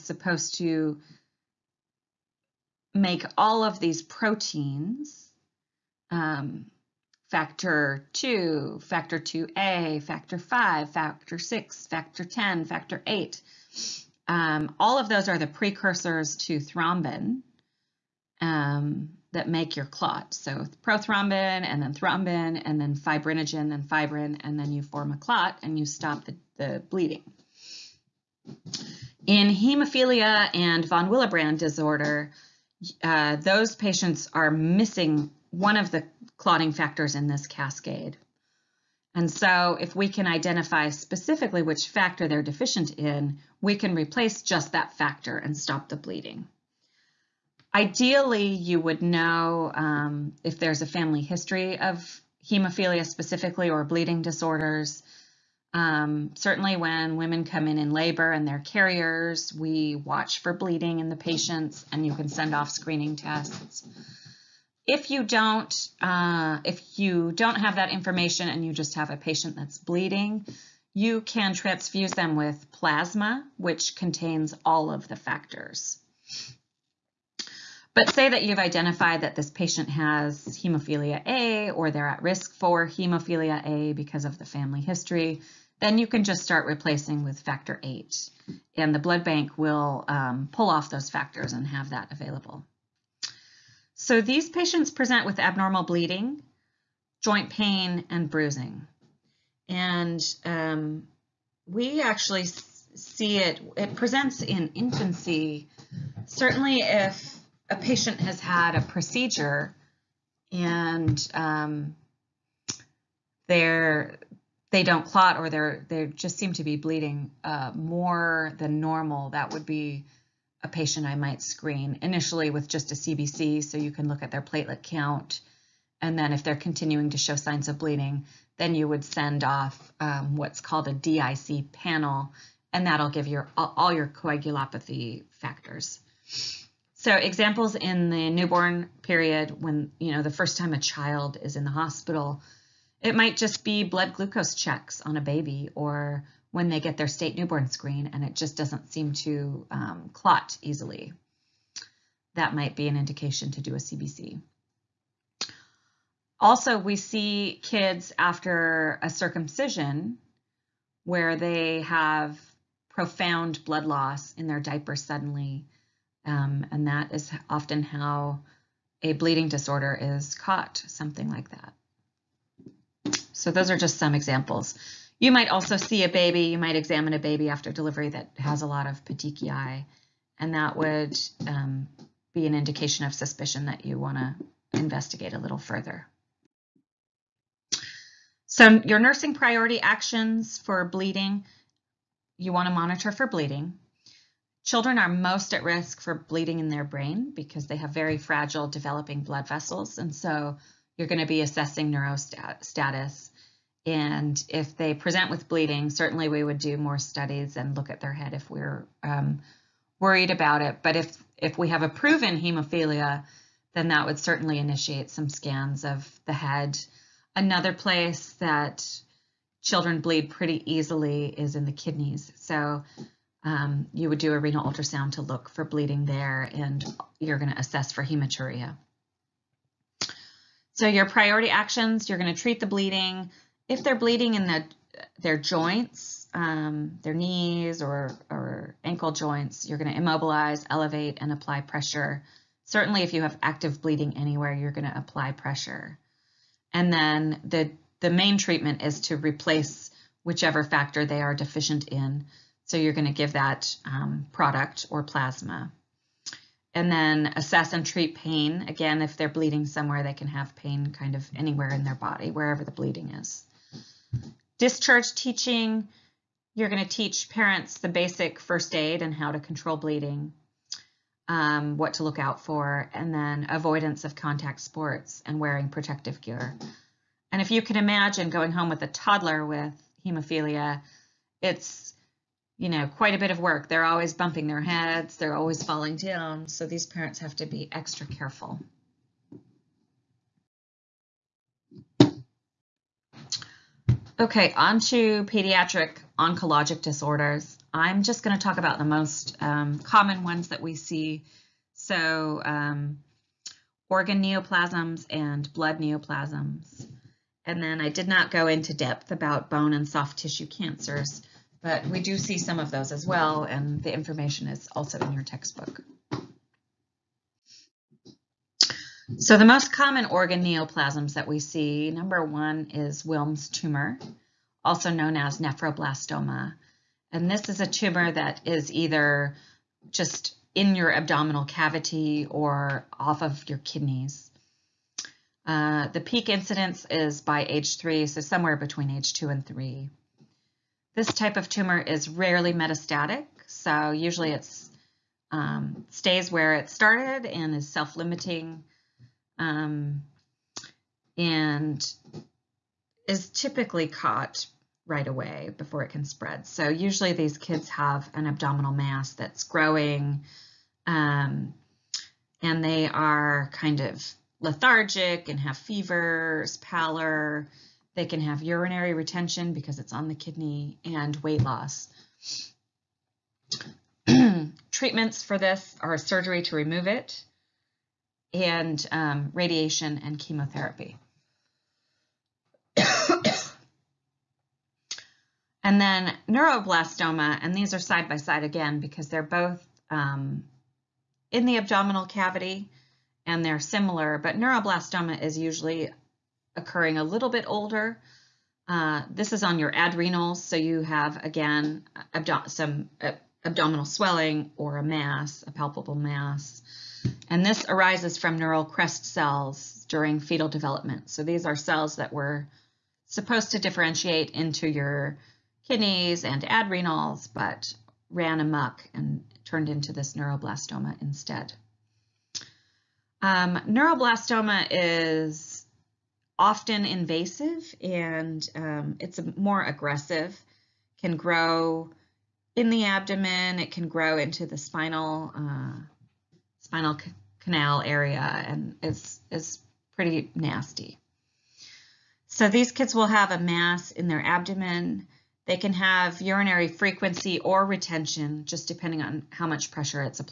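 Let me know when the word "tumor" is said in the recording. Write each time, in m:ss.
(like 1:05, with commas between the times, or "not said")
5:23, 5:27, 5:41.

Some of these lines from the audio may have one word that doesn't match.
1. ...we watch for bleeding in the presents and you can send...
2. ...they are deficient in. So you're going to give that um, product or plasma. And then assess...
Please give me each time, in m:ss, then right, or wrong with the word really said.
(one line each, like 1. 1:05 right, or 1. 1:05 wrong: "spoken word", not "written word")
1. 0:59 wrong: "patients", not "presents"
2. 4:11 right.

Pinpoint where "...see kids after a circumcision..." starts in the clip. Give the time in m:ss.
2:36.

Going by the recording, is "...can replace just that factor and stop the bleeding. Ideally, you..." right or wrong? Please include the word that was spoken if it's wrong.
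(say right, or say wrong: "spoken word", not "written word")
right.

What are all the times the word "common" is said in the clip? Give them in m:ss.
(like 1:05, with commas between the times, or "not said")
4:59, 5:19.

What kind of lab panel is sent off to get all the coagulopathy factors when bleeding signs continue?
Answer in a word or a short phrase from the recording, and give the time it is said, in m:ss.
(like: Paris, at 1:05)
DIC panel, at 2:10.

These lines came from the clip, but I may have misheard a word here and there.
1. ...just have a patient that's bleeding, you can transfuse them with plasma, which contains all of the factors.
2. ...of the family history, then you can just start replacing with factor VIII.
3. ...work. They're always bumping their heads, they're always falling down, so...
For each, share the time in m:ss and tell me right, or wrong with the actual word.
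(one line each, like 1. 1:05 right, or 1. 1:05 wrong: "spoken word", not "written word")
1. 1:08 right
2. 1:24 right
3. 4:43 right.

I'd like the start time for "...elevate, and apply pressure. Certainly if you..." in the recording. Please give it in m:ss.
4:00.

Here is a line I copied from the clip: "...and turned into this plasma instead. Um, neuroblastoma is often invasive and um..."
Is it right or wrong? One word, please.
wrong.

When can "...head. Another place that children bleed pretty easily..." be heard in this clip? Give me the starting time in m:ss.
3:36.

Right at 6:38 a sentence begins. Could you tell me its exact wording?
Uh, this is on your adrenals, so you have, again, abdo some uh, abdominal swelling or a mass, a palpable mass.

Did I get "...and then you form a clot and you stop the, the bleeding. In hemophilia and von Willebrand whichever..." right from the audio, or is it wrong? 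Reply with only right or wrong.
wrong.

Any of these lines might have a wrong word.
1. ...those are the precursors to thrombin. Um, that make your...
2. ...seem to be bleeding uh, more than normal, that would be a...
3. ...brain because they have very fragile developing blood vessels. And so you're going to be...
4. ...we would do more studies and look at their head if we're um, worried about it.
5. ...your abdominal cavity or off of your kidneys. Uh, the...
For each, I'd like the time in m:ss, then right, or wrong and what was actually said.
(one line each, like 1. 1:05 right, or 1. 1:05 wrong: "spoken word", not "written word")
1. 0:15 right
2. 1:56 right
3. 3:16 right
4. 3:26 right
5. 5:30 right.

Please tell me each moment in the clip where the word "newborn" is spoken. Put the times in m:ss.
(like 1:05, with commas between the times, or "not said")
2:18, 2:27.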